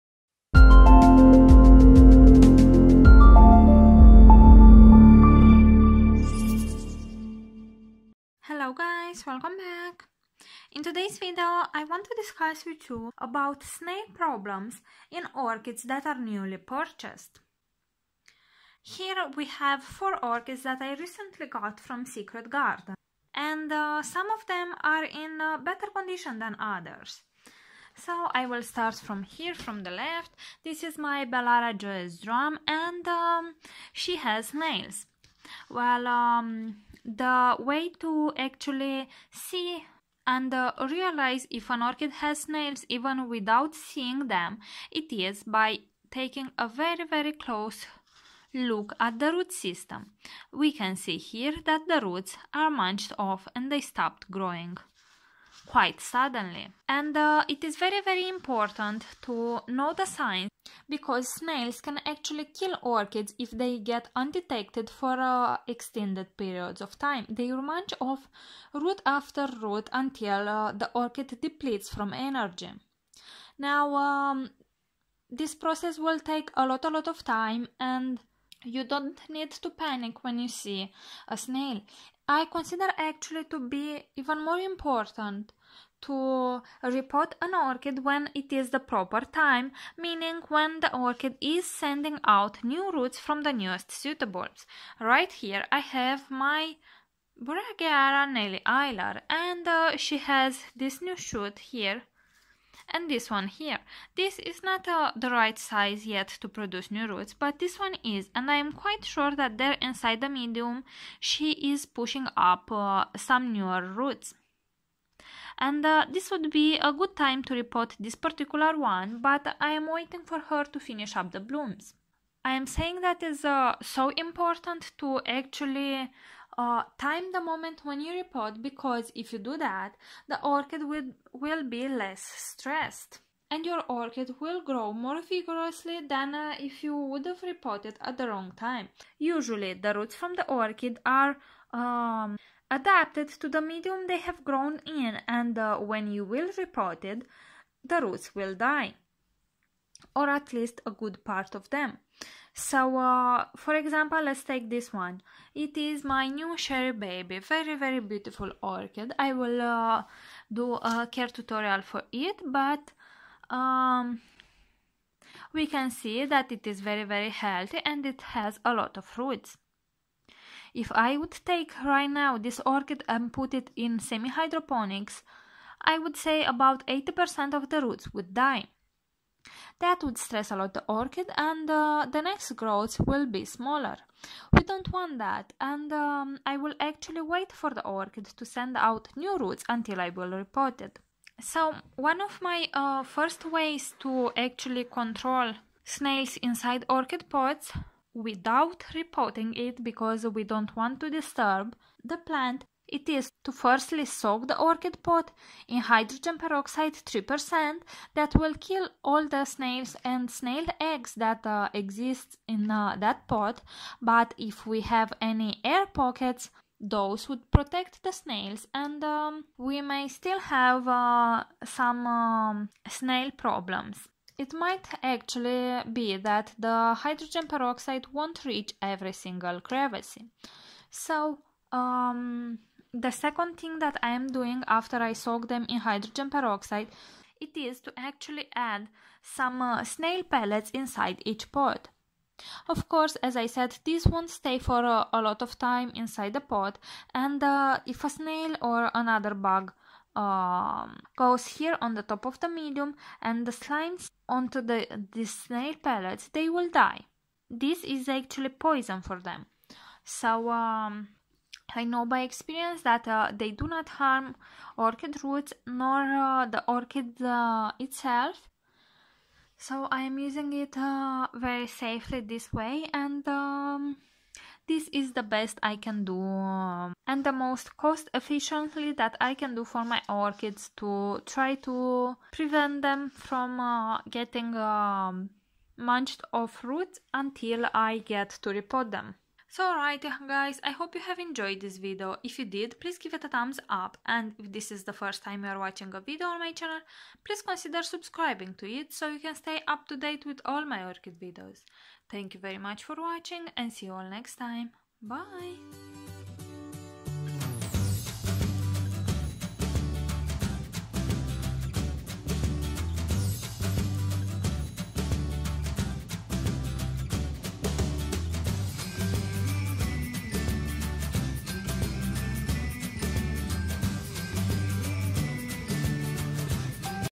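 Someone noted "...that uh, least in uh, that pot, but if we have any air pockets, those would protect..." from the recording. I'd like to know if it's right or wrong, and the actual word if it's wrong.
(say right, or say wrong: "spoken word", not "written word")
wrong: "exist", not "least".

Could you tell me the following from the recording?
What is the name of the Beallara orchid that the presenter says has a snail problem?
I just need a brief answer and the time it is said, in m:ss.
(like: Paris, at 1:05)
Joyous drum, at 0:31.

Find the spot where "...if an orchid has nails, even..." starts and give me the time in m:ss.
0:41.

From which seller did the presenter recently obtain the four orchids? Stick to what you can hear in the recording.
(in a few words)
Secret Garden.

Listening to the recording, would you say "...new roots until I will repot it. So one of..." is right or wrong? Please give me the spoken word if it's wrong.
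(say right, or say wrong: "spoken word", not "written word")
right.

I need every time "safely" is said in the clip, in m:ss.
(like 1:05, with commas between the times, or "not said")
4:31.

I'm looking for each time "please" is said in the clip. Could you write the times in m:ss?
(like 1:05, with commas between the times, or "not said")
4:52, 4:57.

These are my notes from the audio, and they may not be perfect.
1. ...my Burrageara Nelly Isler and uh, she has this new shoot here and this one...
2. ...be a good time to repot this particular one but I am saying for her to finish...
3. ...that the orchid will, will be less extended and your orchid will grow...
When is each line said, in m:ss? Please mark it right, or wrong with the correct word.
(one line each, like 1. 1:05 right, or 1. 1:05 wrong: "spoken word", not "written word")
1. 1:36 right
2. 1:56 wrong: "waiting", not "saying"
3. 2:09 wrong: "stressed", not "extended".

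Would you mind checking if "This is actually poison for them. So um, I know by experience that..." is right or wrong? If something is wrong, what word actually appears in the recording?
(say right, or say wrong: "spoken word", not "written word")
right.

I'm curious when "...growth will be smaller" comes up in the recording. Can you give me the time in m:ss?
3:02.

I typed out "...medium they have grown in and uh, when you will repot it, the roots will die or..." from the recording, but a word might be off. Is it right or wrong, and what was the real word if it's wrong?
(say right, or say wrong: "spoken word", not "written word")
right.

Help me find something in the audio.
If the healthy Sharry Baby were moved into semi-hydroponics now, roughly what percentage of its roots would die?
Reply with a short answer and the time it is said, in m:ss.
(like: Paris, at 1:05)
80%, at 2:56.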